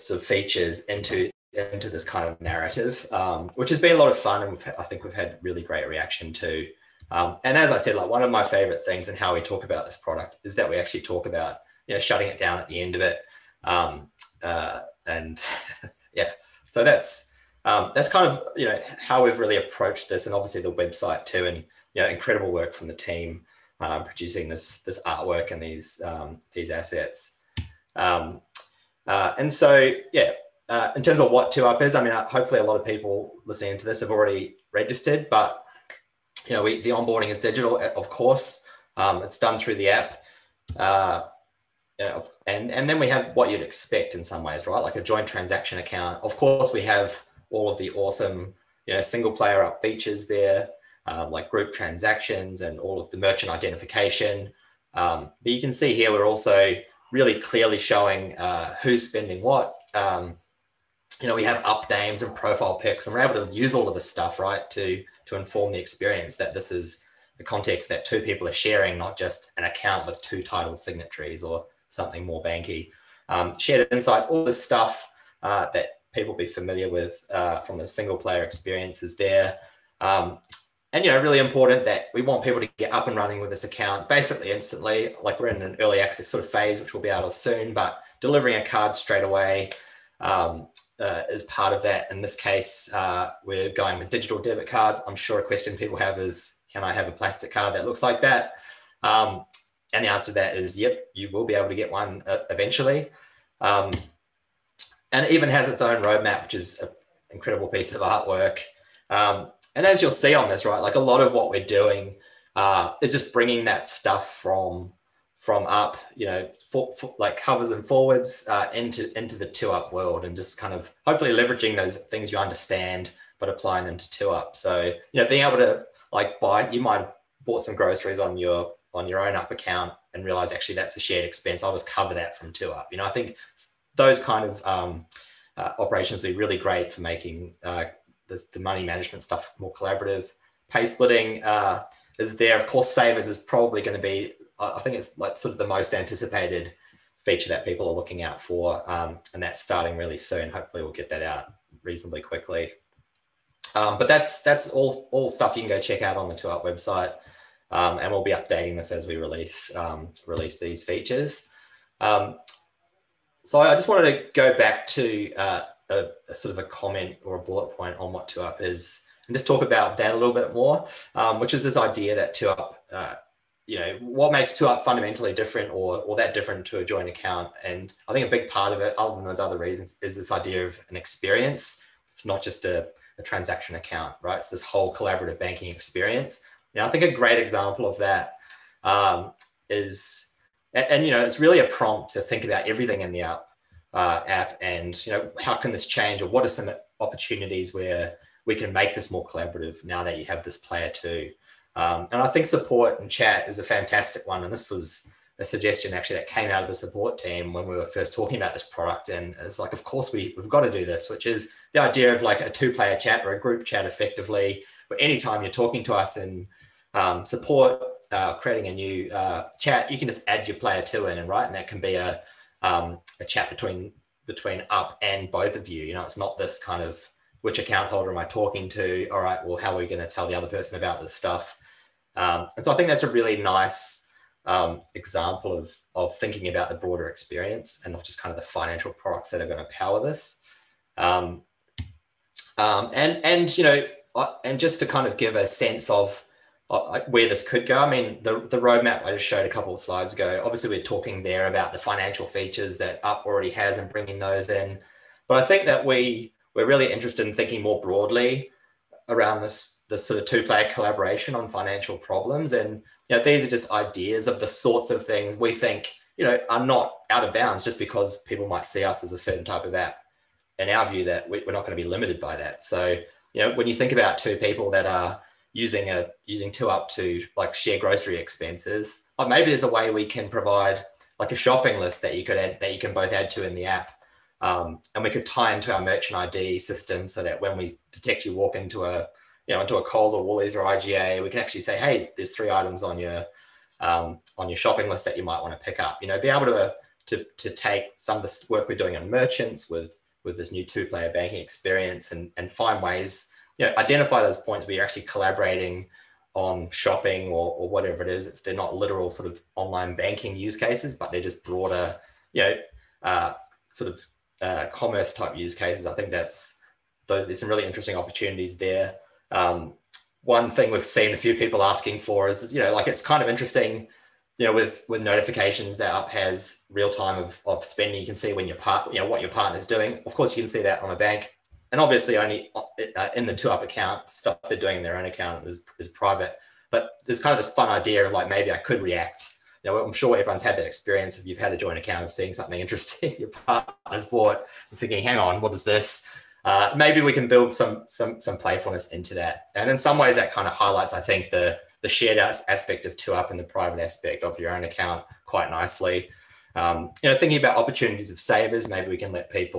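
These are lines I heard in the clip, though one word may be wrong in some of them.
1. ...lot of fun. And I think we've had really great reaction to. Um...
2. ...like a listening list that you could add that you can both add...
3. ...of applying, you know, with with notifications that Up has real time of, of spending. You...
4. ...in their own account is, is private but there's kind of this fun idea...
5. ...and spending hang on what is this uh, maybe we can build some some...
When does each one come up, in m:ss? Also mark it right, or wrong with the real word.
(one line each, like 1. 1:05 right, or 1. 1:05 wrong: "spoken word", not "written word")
1. 0:03 right
2. 4:41 wrong: "shopping", not "listening"
3. 5:23 wrong: "interesting", not "applying"
4. 5:34 right
5. 5:44 wrong: "thinking", not "spending".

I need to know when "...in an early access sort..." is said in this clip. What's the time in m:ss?
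1:25.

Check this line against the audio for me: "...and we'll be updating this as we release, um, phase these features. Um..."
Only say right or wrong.
wrong.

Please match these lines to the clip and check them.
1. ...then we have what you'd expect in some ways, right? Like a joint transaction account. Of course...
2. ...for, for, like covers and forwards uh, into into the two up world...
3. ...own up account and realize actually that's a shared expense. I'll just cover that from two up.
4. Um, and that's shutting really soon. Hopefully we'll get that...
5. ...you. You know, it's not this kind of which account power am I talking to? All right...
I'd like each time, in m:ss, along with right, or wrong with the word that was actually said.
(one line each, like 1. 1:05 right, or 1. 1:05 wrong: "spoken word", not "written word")
1. 0:42 right
2. 1:56 right
3. 2:09 right
4. 2:28 wrong: "starting", not "shutting"
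5. 3:45 wrong: "holder", not "power".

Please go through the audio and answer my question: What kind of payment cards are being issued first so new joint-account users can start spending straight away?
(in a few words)
Digital debit cards.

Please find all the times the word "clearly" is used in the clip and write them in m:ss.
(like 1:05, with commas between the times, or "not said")
0:57.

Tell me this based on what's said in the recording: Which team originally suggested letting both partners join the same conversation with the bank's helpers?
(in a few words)
The support team.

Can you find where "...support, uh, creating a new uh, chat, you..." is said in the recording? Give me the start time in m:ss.
3:37.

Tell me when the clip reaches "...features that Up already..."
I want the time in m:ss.
4:12.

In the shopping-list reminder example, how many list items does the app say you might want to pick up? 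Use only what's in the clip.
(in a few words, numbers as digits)
3.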